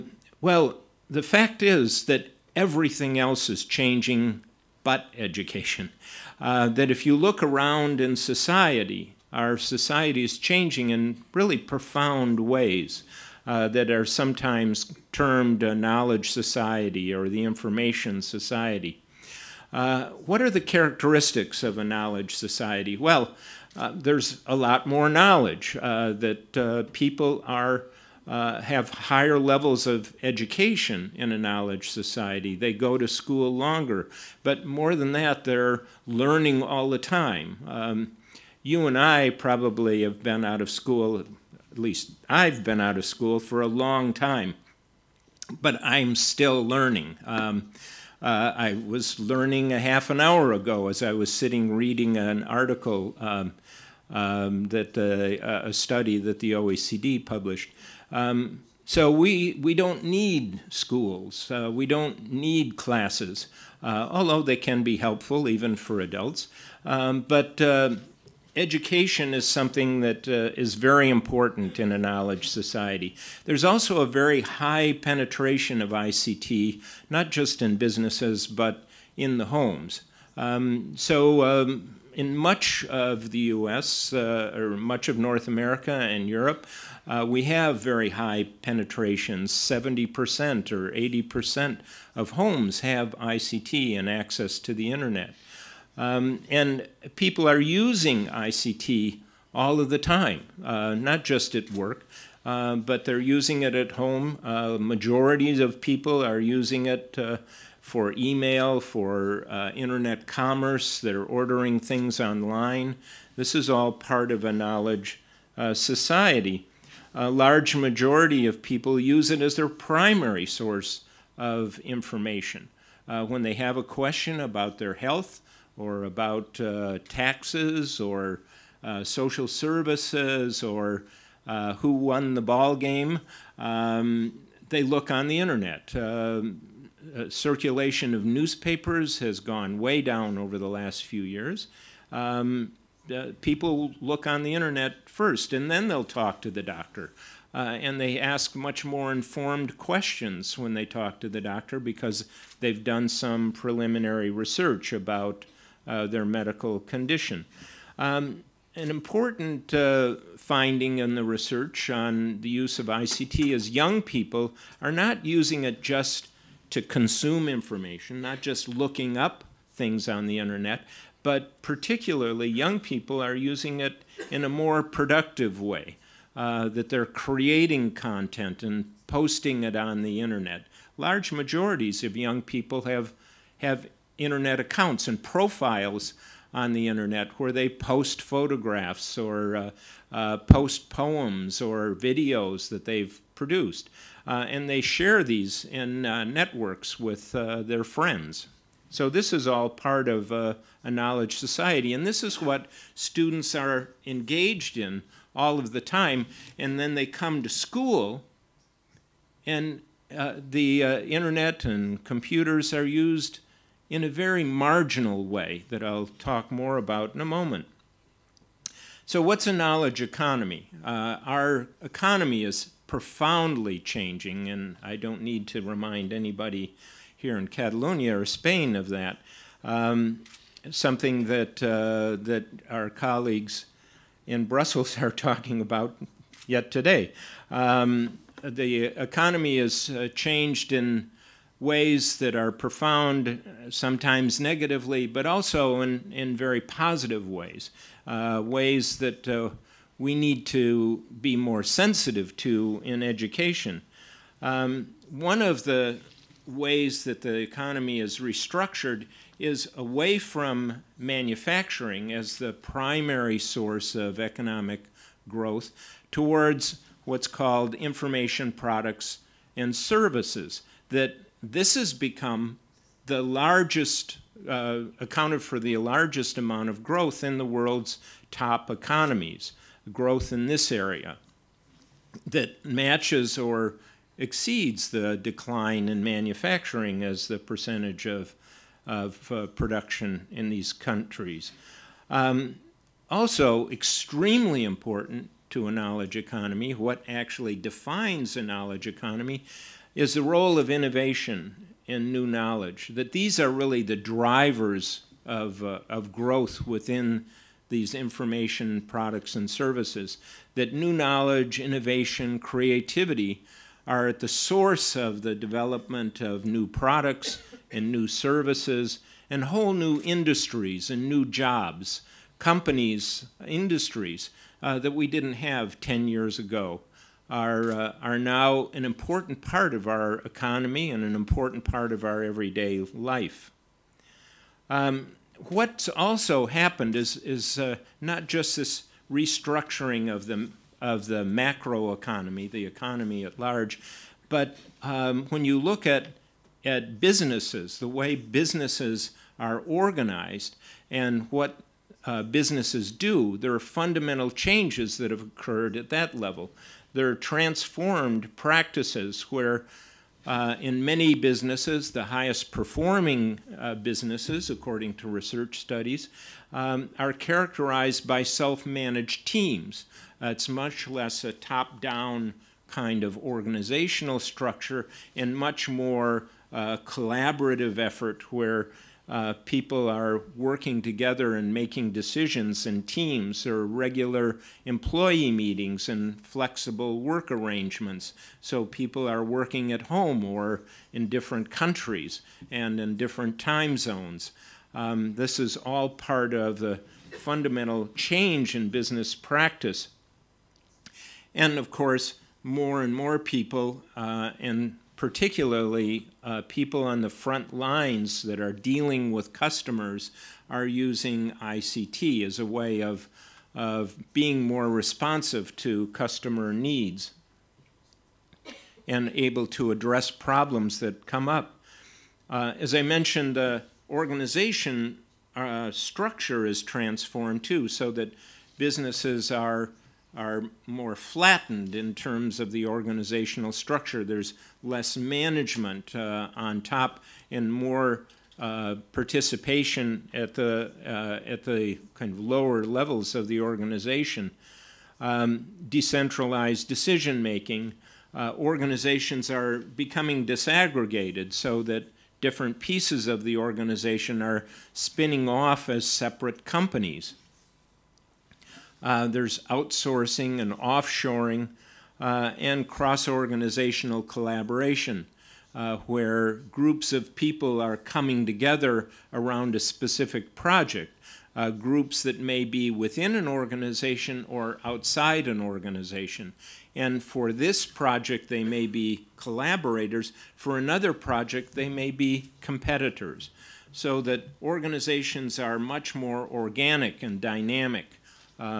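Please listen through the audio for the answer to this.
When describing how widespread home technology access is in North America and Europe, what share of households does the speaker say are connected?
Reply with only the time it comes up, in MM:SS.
01:29.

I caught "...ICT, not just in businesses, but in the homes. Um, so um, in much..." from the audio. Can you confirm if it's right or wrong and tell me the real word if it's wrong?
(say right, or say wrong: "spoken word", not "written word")
right.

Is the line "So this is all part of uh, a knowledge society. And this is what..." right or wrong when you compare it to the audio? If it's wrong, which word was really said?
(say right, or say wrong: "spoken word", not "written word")
right.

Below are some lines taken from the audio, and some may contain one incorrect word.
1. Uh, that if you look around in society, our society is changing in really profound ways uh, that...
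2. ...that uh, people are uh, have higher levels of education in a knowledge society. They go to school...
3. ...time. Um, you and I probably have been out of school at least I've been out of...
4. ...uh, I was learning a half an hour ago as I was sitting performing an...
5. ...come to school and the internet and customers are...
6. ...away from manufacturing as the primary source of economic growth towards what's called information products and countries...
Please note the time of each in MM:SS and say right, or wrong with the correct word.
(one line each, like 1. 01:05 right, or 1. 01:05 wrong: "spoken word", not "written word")
1. 00:06 right
2. 00:26 right
3. 00:36 right
4. 00:48 wrong: "reading", not "performing"
5. 03:27 wrong: "computers", not "customers"
6. 04:19 wrong: "services", not "countries".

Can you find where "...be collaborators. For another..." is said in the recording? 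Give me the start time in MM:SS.
07:58.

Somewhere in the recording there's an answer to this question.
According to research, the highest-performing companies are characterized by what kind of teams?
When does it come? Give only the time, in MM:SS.
06:08.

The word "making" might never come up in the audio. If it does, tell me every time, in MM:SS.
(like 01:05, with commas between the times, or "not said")
06:21, 07:27.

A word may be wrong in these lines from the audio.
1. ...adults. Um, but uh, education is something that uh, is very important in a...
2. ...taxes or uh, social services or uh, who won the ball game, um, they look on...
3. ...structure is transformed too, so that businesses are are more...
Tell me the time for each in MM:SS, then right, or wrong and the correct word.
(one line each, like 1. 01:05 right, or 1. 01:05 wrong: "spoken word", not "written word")
1. 01:06 right
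2. 02:07 right
3. 07:05 right.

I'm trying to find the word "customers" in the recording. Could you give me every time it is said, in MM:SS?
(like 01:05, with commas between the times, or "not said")
06:49, 06:55.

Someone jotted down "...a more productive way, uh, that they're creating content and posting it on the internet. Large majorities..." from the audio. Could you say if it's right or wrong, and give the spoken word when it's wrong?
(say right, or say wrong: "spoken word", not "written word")
right.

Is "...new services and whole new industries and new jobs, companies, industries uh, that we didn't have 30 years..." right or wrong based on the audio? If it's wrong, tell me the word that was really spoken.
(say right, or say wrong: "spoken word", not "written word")
wrong: "10", not "30".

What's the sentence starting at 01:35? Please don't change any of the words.
Um, and people are using ICT all of the time, uh, not just at work, uh, but they're using it at home.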